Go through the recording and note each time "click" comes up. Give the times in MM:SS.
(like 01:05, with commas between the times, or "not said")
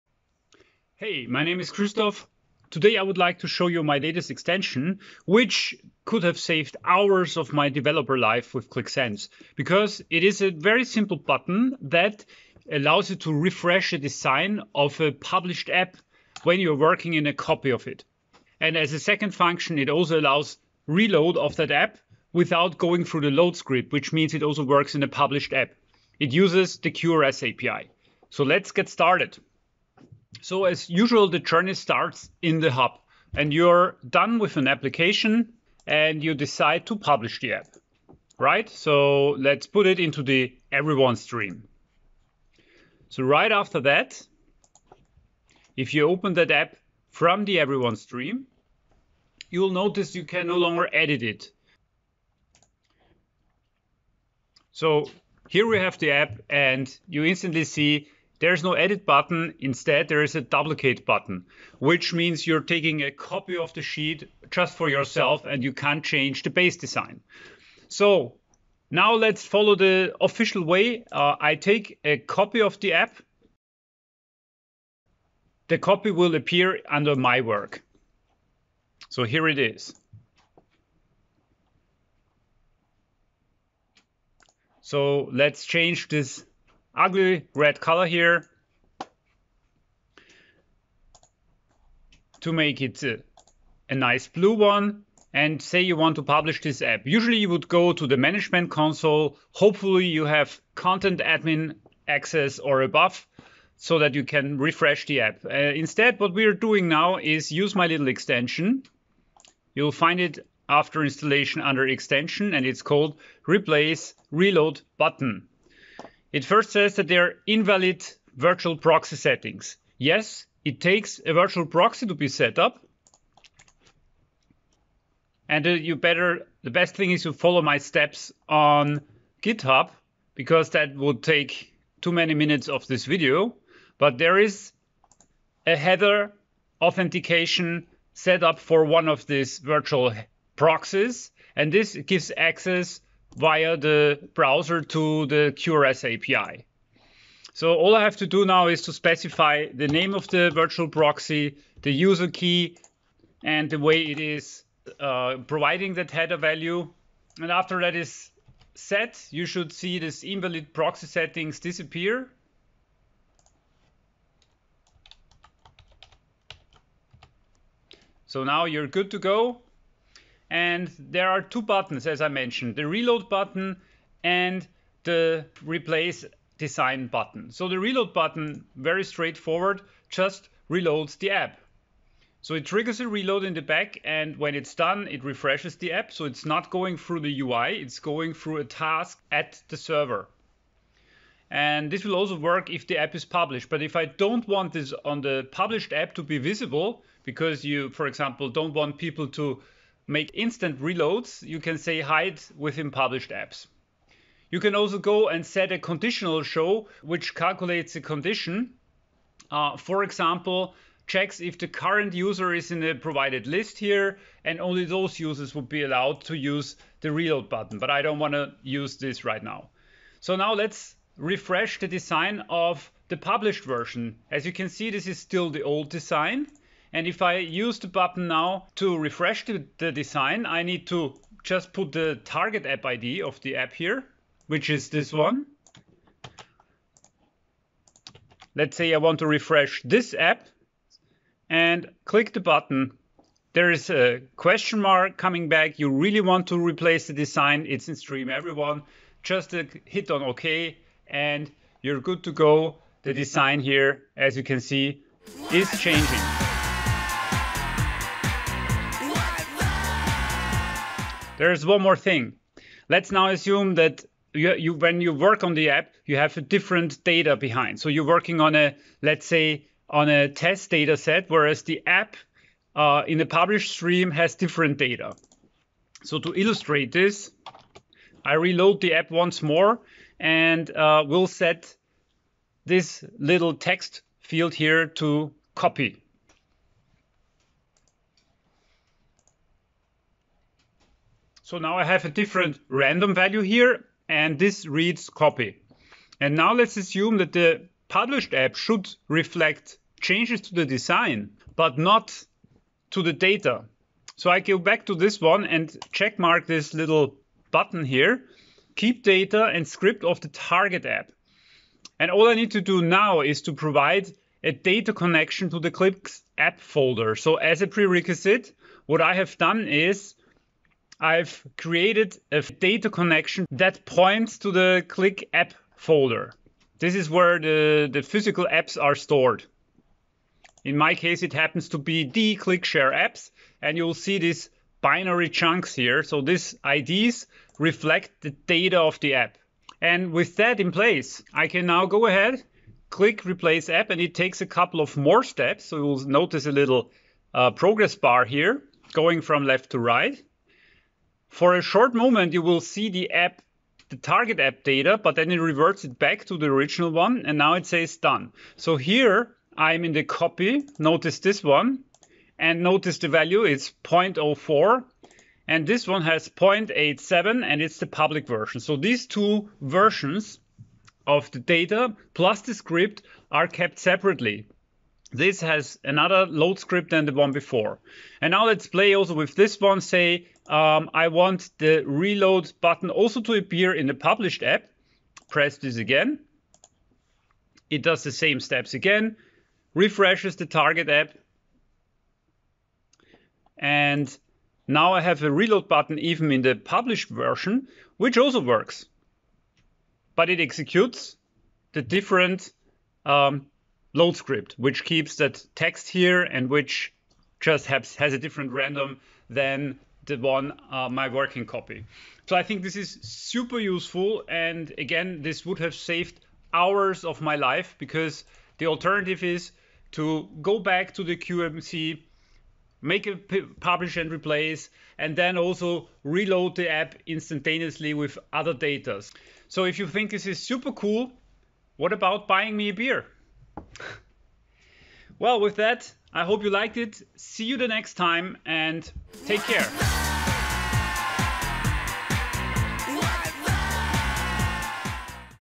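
04:02, 05:42.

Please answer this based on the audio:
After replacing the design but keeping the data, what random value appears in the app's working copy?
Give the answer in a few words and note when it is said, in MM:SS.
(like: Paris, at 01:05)
0.04, at 06:03.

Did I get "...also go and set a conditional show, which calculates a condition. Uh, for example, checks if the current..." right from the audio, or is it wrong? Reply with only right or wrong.
right.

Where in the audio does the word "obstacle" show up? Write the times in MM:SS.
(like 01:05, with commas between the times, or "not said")
not said.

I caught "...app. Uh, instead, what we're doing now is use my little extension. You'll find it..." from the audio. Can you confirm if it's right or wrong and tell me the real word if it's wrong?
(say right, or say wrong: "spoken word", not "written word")
right.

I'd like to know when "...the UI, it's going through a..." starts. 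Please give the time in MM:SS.
03:07.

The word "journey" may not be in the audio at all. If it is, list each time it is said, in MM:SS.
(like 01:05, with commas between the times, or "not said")
00:31.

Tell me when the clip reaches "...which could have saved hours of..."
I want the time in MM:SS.
00:05.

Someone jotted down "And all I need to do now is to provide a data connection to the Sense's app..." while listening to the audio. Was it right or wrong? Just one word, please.
wrong.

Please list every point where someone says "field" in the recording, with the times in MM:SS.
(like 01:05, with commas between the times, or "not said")
04:44.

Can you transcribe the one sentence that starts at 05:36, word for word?
So these IDs reflect the data of the app.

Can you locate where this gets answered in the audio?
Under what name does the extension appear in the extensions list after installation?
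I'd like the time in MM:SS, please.
01:53.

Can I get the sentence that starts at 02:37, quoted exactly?
And after that is set, you should see this invalid proxy settings disappear.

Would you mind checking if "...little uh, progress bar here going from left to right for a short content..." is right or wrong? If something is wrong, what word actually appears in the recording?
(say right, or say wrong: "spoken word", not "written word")
wrong: "moment", not "content".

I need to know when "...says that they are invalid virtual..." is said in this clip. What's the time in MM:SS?
01:56.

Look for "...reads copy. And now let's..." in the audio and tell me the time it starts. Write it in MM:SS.
04:54.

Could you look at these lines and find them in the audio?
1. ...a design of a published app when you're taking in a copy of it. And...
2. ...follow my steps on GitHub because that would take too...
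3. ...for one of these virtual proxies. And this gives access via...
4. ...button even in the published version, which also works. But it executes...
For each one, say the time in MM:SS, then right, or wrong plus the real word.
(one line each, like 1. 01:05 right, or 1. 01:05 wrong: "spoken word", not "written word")
1. 00:13 wrong: "working", not "taking"
2. 02:07 right
3. 02:18 right
4. 06:35 right.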